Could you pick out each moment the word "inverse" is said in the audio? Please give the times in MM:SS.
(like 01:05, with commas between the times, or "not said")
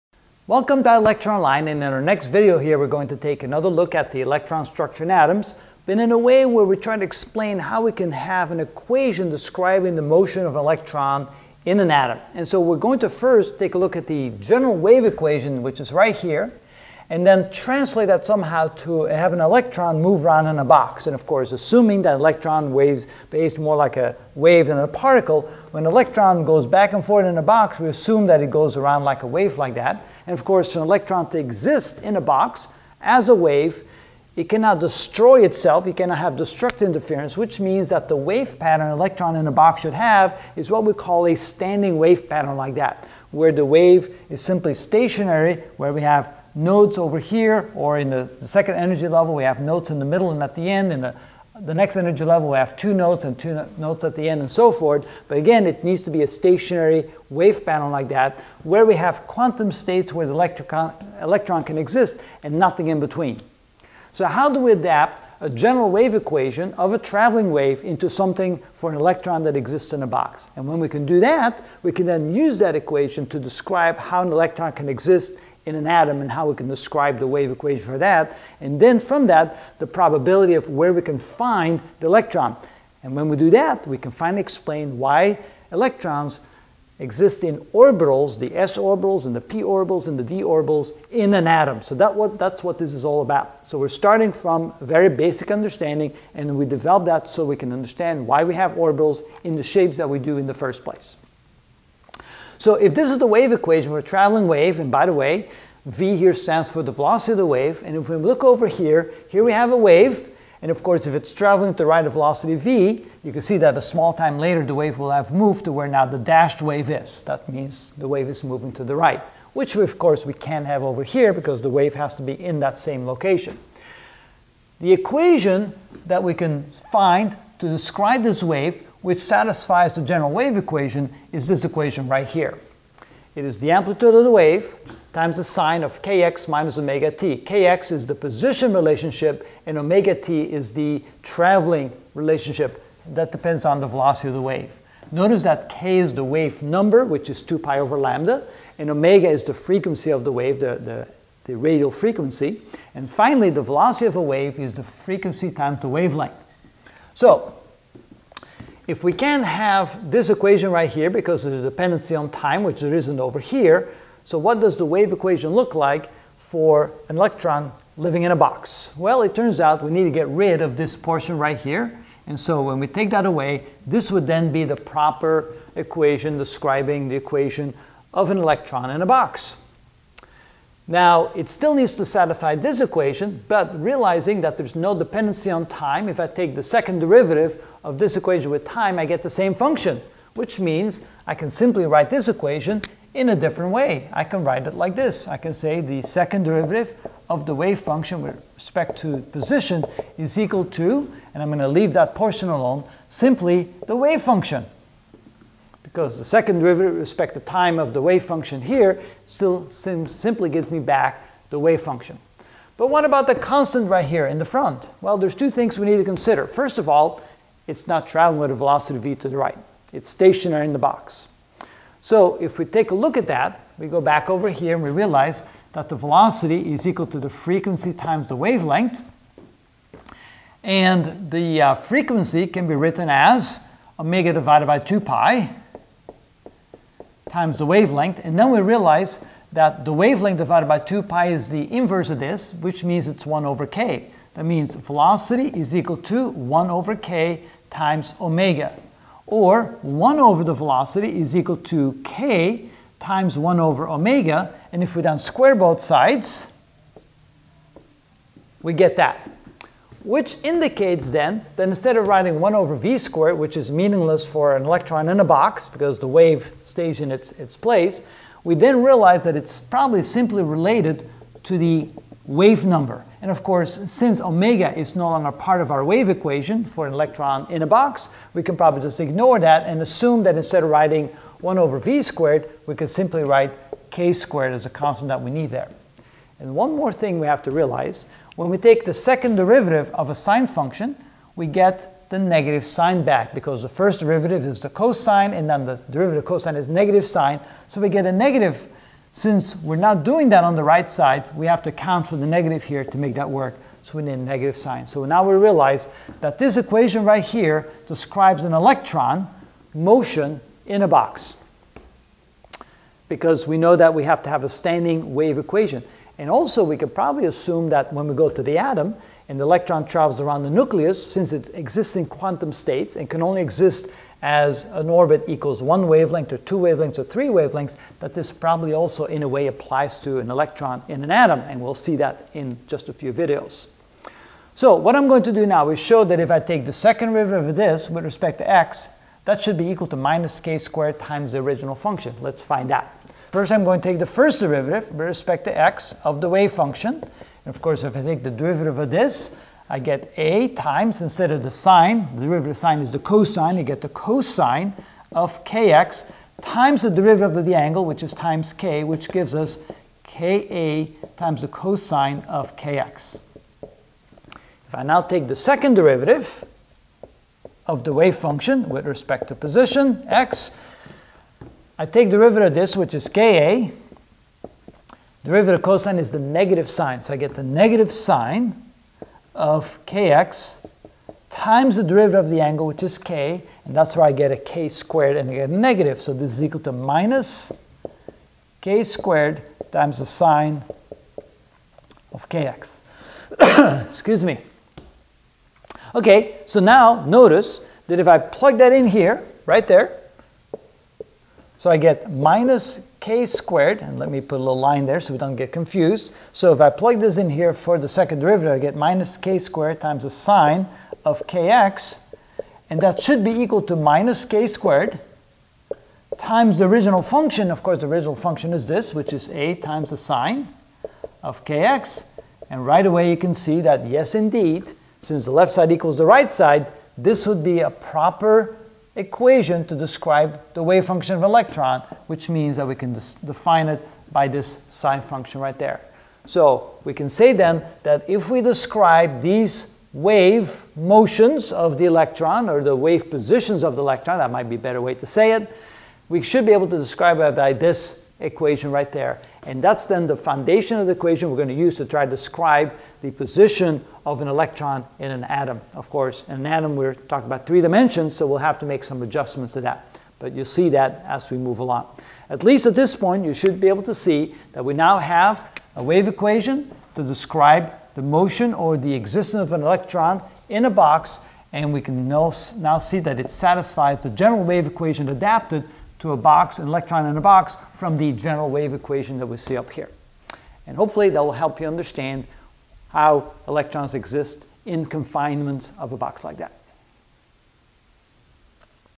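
04:01.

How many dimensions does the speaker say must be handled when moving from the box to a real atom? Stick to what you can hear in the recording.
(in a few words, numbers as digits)
3.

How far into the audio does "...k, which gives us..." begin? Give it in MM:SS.
05:58.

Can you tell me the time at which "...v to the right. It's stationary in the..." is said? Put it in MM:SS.
03:38.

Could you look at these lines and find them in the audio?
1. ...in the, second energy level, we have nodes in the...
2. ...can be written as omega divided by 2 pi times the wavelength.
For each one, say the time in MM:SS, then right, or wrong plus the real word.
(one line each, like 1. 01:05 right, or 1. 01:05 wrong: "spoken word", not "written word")
1. 00:47 right
2. 03:52 right.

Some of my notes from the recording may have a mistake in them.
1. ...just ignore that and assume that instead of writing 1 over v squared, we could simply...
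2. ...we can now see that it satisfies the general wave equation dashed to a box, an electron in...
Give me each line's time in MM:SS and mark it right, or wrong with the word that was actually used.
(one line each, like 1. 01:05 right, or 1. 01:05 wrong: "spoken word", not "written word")
1. 04:38 right
2. 07:51 wrong: "adapted", not "dashed".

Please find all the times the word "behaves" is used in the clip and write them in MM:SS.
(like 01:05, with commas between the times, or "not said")
00:23.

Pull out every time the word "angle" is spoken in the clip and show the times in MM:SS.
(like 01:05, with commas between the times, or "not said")
05:57, 06:22.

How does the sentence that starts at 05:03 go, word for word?
So we need a negative sign.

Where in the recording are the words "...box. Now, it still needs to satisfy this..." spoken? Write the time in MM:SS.
02:59.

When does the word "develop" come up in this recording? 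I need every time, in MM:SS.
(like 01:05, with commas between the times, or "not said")
01:36.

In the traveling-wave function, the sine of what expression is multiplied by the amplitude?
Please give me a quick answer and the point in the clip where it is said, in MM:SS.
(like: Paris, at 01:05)
kx minus omega t, at 02:16.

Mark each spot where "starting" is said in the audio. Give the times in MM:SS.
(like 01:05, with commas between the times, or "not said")
01:33.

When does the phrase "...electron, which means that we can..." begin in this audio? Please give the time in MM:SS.
07:11.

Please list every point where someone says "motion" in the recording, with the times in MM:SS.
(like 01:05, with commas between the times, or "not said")
00:10, 05:09, 07:20, 07:48.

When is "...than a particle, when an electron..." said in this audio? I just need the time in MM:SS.
00:24.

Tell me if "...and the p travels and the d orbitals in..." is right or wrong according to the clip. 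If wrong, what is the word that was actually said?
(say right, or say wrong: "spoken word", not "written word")
wrong: "orbitals", not "travels".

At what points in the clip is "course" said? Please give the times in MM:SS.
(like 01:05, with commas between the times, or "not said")
00:21, 00:30, 01:50, 01:59, 04:33, 05:47, 06:57, 07:35.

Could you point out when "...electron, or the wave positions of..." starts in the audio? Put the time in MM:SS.
07:21.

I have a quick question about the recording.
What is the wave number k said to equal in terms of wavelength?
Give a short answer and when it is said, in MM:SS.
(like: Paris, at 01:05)
2 pi over lambda, at 02:27.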